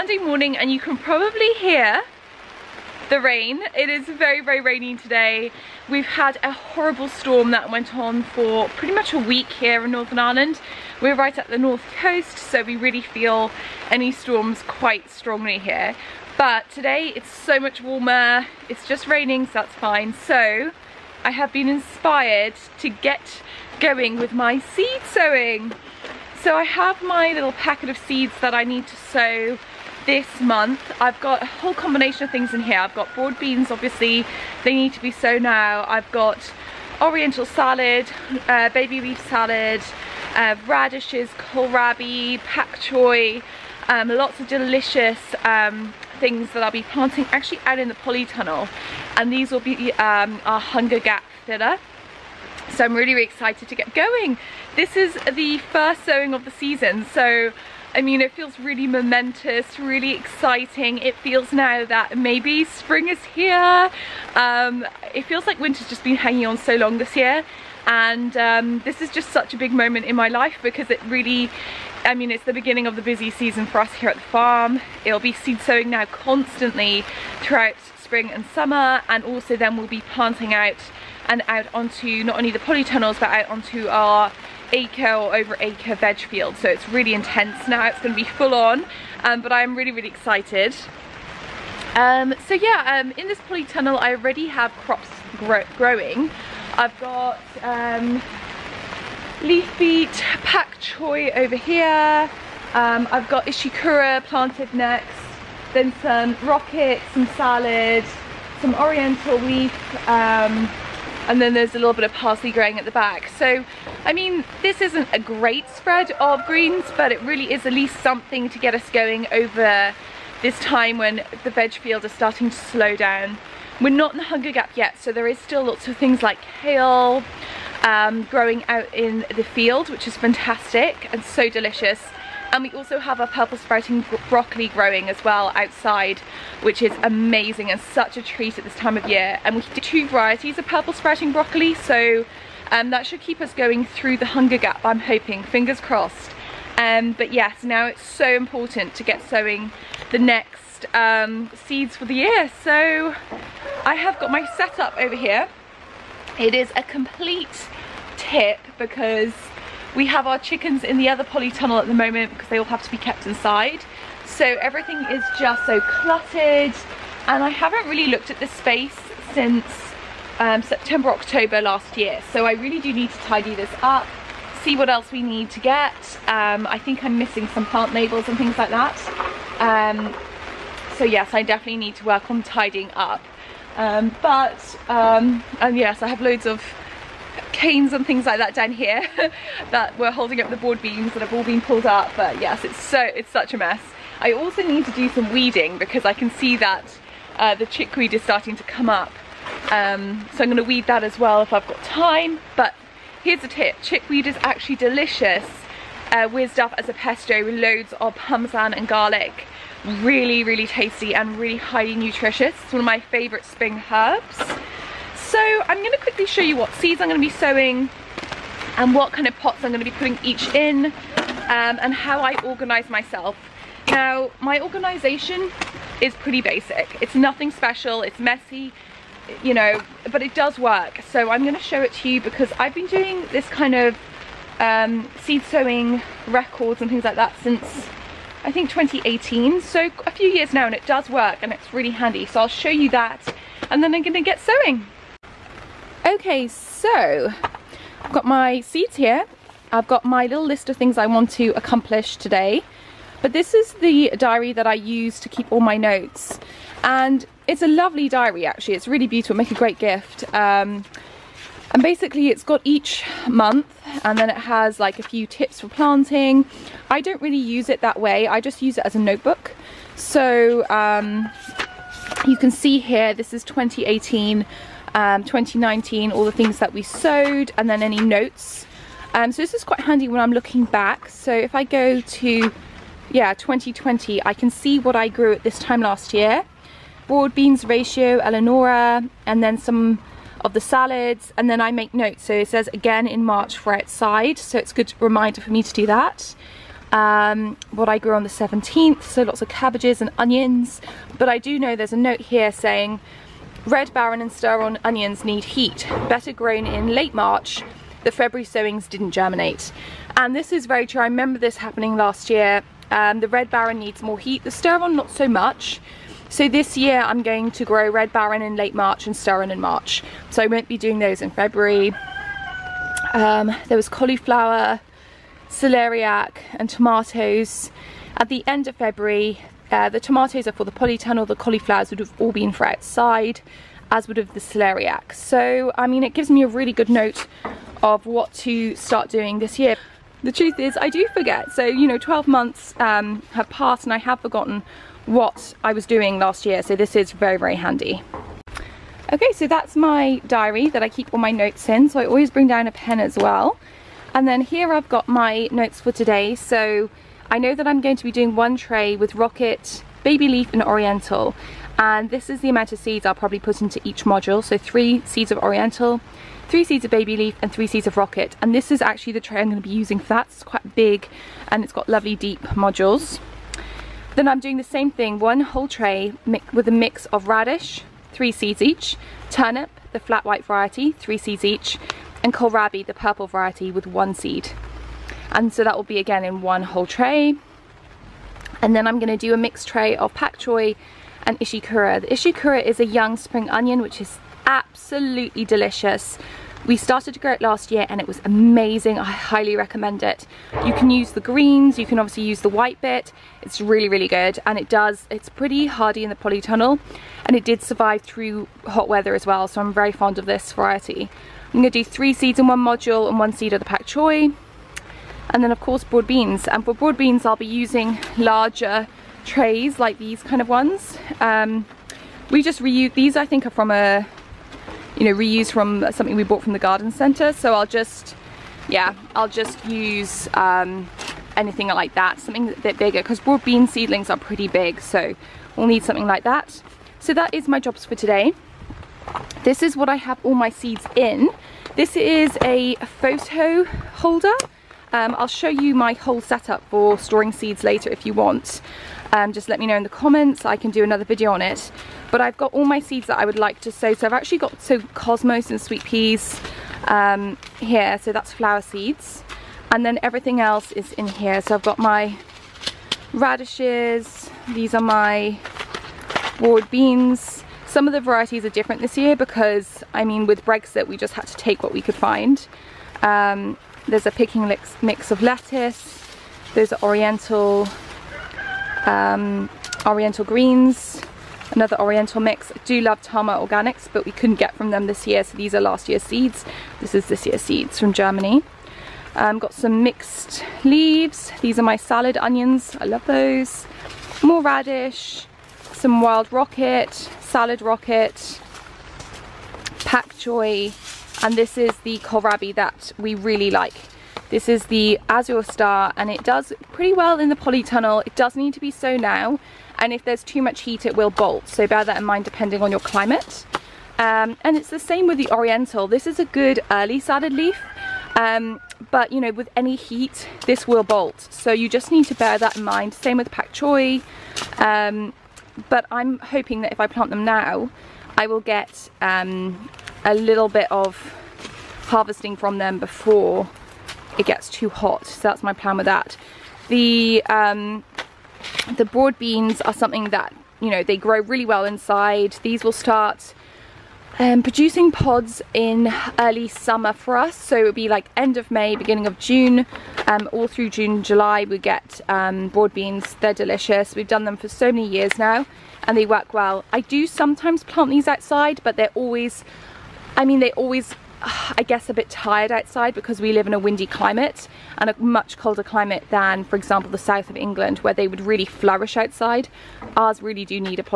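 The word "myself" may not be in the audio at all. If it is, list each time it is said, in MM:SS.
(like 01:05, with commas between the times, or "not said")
03:42.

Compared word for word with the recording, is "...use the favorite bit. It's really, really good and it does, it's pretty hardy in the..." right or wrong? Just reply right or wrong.
wrong.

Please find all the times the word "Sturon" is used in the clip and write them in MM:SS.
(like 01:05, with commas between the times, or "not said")
05:04, 05:14, 05:19.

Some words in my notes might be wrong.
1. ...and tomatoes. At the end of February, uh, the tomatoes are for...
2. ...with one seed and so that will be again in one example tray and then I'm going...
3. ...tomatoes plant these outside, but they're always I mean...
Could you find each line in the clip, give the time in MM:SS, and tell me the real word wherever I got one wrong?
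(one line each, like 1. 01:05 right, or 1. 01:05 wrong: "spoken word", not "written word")
1. 05:26 right
2. 06:23 wrong: "whole", not "example"
3. 09:17 wrong: "sometimes", not "tomatoes".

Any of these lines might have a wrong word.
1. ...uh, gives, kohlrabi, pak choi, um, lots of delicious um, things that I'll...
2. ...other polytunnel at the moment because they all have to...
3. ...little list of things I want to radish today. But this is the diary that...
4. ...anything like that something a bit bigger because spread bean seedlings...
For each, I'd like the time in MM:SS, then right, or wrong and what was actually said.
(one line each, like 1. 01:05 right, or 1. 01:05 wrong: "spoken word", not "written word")
1. 00:40 wrong: "radishes", not "gives"
2. 02:41 right
3. 04:10 wrong: "accomplish", not "radish"
4. 07:11 wrong: "broad", not "spread".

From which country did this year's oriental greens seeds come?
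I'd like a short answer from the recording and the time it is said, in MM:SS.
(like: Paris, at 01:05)
Germany, at 08:07.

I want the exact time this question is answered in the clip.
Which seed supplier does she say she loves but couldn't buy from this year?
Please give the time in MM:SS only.
08:03.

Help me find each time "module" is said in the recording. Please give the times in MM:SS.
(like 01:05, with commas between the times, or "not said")
06:04, 06:12, 06:52.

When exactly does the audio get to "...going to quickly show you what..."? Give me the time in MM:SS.
03:35.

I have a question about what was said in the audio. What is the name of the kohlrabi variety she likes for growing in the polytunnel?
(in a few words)
Azure Star.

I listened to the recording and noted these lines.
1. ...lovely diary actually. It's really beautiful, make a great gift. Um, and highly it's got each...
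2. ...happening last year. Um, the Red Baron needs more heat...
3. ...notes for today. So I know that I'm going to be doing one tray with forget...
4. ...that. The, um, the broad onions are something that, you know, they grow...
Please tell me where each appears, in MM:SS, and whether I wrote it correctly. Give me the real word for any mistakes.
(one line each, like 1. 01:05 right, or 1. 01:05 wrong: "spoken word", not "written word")
1. 04:17 wrong: "basically", not "highly"
2. 05:11 right
3. 05:55 wrong: "rocket", not "forget"
4. 08:55 wrong: "beans", not "onions".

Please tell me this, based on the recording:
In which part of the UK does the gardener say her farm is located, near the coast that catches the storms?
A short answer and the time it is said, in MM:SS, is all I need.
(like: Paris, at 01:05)
Northern Ireland, at 00:09.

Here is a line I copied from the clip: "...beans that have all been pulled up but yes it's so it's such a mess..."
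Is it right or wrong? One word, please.
right.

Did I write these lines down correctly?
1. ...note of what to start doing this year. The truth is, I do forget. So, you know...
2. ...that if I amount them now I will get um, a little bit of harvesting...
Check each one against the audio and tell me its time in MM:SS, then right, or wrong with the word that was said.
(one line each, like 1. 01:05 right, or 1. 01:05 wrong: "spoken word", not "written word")
1. 05:36 right
2. 08:46 wrong: "plant", not "amount".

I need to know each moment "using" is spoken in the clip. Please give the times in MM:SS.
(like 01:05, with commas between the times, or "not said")
06:09, 06:57.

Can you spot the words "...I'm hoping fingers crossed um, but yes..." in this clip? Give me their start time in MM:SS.
02:24.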